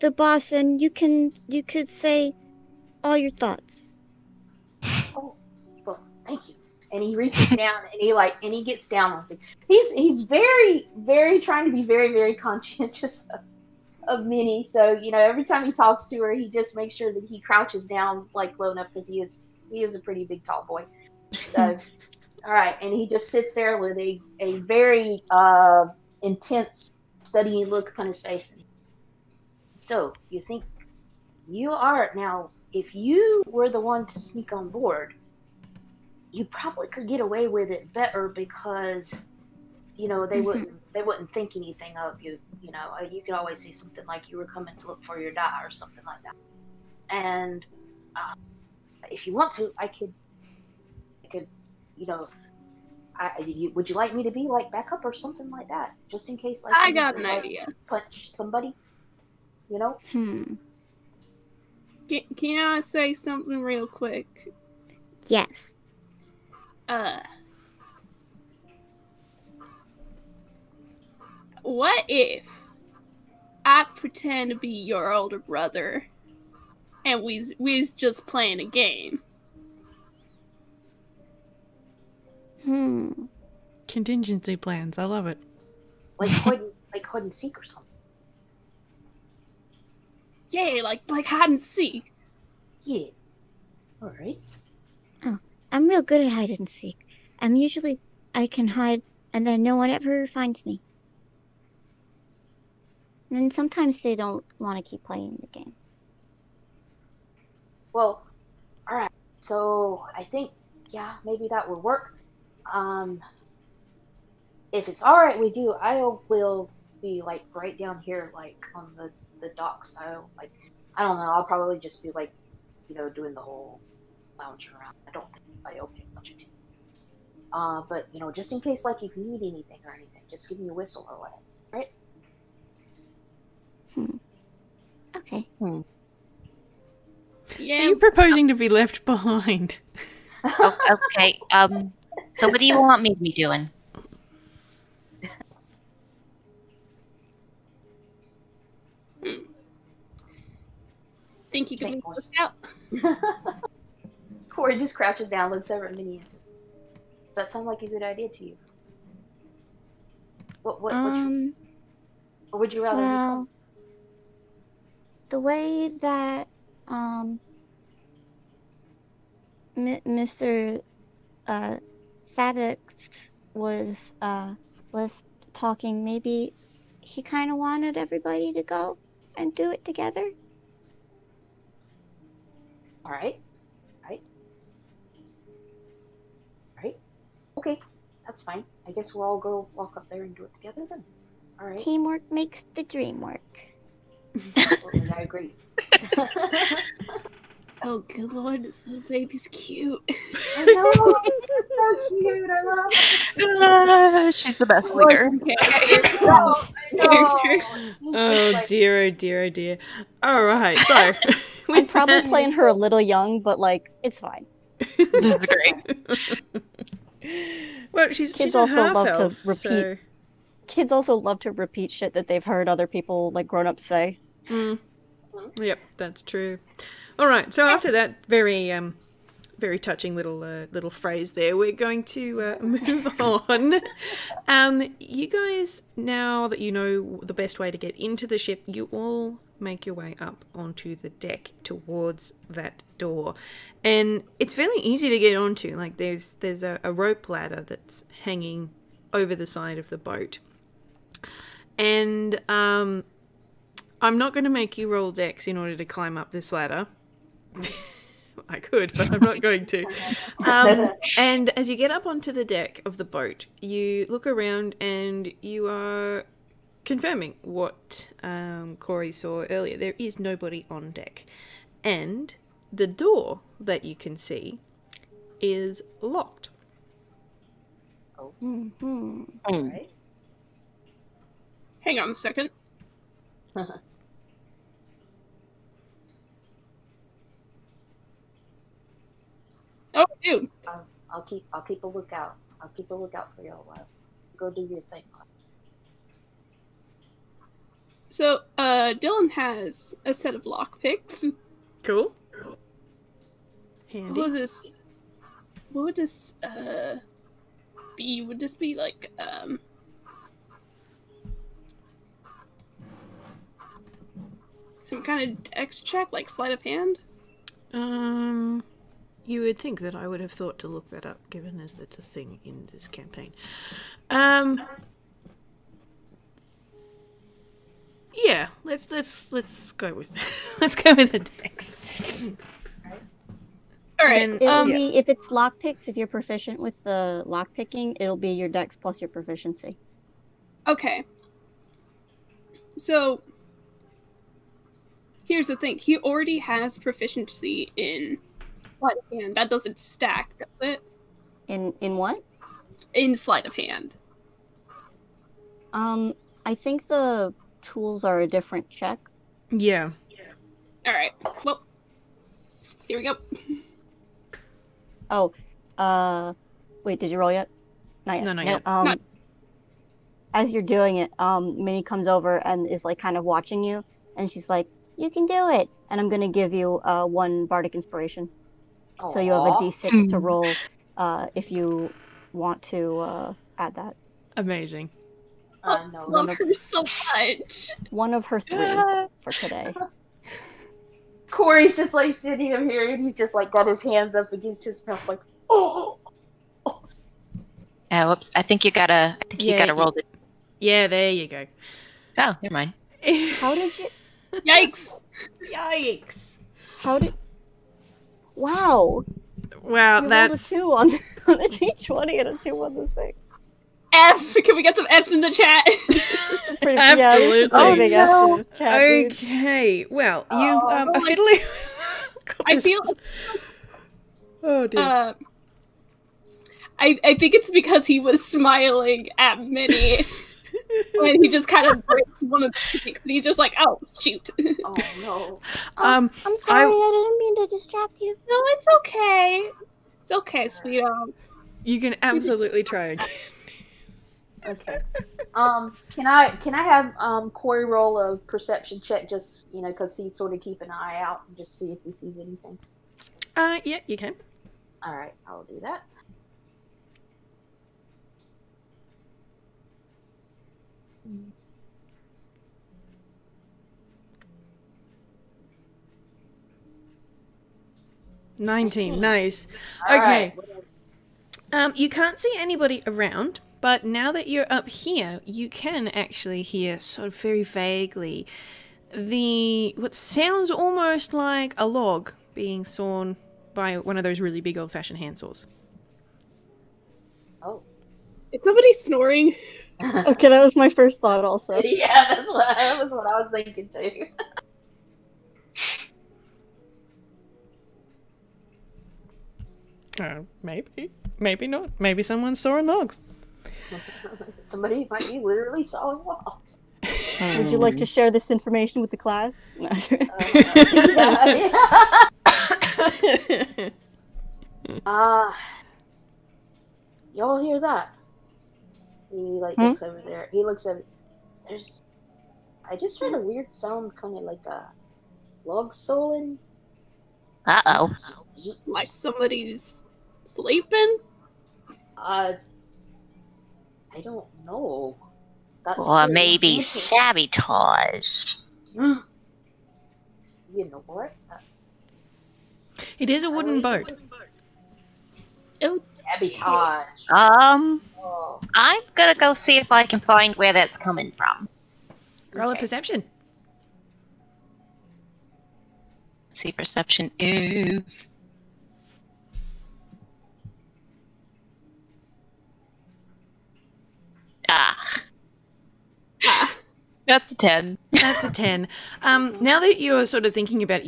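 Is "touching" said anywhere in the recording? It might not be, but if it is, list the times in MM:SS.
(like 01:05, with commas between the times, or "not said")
03:49.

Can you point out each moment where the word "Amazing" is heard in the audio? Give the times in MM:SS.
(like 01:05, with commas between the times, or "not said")
06:24.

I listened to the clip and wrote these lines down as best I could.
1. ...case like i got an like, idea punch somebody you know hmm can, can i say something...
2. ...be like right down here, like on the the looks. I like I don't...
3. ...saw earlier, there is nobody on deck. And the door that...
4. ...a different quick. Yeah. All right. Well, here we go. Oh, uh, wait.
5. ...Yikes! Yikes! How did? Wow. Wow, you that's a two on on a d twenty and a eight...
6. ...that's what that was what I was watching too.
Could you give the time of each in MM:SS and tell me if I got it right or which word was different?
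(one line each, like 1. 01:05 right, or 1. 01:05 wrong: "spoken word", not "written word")
1. 00:56 right
2. 01:57 wrong: "docks", not "looks"
3. 04:29 right
4. 05:58 wrong: "check", not "quick"
5. 06:44 wrong: "two", not "eight"
6. 08:12 wrong: "thinking", not "watching".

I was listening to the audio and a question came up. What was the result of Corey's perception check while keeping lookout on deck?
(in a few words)
19.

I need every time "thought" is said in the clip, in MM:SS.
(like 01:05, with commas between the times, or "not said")
00:03, 05:20, 08:11.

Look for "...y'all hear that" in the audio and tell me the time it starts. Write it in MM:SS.
08:37.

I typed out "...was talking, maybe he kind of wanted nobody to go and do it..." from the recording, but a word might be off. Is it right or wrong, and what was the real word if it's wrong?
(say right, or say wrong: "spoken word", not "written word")
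wrong: "everybody", not "nobody".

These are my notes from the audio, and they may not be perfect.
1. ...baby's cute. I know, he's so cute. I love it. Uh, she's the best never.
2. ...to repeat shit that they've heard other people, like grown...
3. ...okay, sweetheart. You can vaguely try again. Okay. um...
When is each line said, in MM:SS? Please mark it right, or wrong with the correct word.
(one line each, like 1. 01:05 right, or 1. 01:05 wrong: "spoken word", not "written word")
1. 03:19 wrong: "leader", not "never"
2. 03:41 right
3. 07:20 wrong: "absolutely", not "vaguely".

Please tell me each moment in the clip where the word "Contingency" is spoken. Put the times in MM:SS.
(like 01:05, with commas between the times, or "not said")
01:23.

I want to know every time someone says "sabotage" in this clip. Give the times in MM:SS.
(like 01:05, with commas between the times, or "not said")
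08:56, 09:05.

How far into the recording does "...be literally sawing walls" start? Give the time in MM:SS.
08:25.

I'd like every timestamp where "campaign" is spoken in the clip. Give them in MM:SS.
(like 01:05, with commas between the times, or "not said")
05:22.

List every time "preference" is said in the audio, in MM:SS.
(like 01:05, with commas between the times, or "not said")
not said.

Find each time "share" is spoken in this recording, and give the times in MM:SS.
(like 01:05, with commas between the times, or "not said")
08:27.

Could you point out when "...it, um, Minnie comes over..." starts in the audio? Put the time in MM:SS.
06:10.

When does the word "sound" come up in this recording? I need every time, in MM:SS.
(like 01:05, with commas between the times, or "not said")
02:37, 07:59, 08:43.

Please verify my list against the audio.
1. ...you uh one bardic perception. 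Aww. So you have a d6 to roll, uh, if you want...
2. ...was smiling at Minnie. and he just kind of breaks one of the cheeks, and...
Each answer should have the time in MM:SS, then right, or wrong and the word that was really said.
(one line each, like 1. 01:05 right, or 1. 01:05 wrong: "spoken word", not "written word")
1. 06:16 wrong: "inspiration", not "perception"
2. 07:08 right.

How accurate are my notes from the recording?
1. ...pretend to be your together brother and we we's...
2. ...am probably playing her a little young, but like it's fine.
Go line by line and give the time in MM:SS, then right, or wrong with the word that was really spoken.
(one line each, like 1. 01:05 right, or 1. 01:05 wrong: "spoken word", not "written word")
1. 01:13 wrong: "older", not "together"
2. 03:31 right.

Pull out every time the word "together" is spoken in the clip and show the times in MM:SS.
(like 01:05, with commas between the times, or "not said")
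02:59, 03:10.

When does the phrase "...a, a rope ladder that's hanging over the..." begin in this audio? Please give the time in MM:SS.
04:06.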